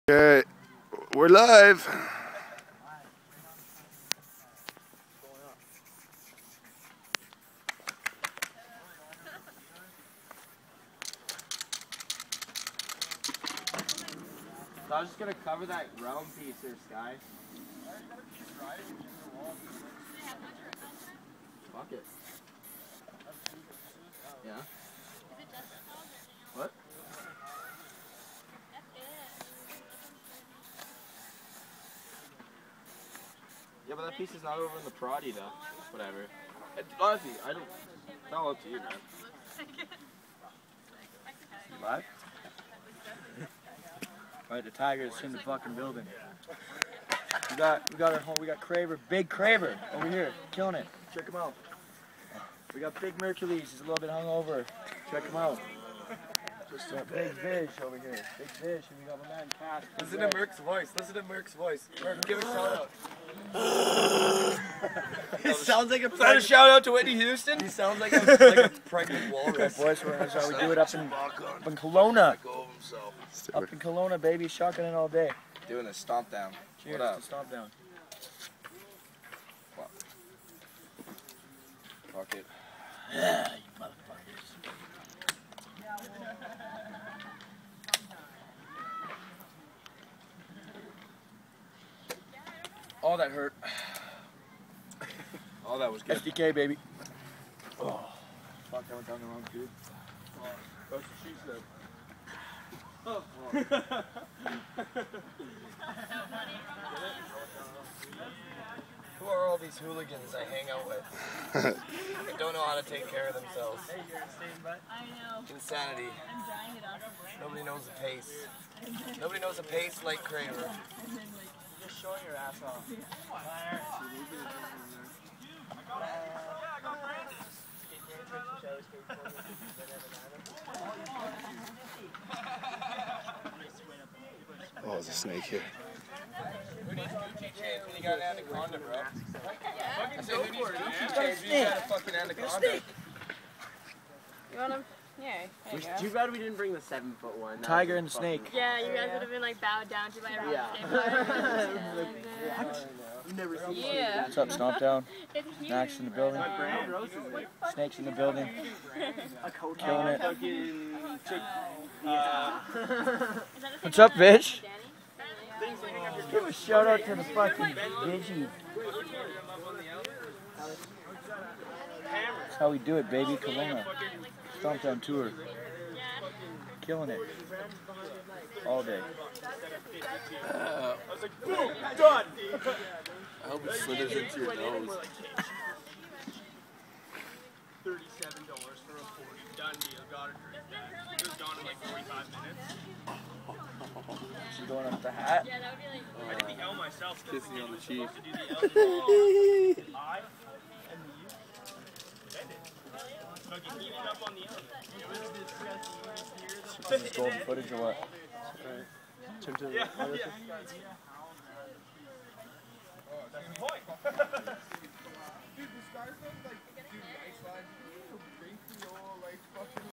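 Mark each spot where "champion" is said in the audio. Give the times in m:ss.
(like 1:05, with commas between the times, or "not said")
2:17.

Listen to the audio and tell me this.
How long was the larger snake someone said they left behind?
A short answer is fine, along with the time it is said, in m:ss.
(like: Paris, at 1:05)
7 foot 1, at 2:26.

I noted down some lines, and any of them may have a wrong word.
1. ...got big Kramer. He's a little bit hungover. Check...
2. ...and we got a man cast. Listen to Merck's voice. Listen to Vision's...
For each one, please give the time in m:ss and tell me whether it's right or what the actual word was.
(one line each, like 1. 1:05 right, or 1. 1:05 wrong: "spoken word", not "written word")
1. 0:52 wrong: "Mercules", not "Kramer"
2. 0:58 wrong: "Merck", not "Vision".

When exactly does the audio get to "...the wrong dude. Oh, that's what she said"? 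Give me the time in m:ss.
1:39.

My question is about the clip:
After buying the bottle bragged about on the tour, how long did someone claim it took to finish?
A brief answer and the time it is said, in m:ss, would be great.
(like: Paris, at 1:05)
45 minutes, at 3:11.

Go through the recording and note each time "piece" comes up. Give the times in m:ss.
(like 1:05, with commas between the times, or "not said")
0:16, 0:34.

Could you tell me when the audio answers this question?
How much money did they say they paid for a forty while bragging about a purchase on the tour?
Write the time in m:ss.
3:04.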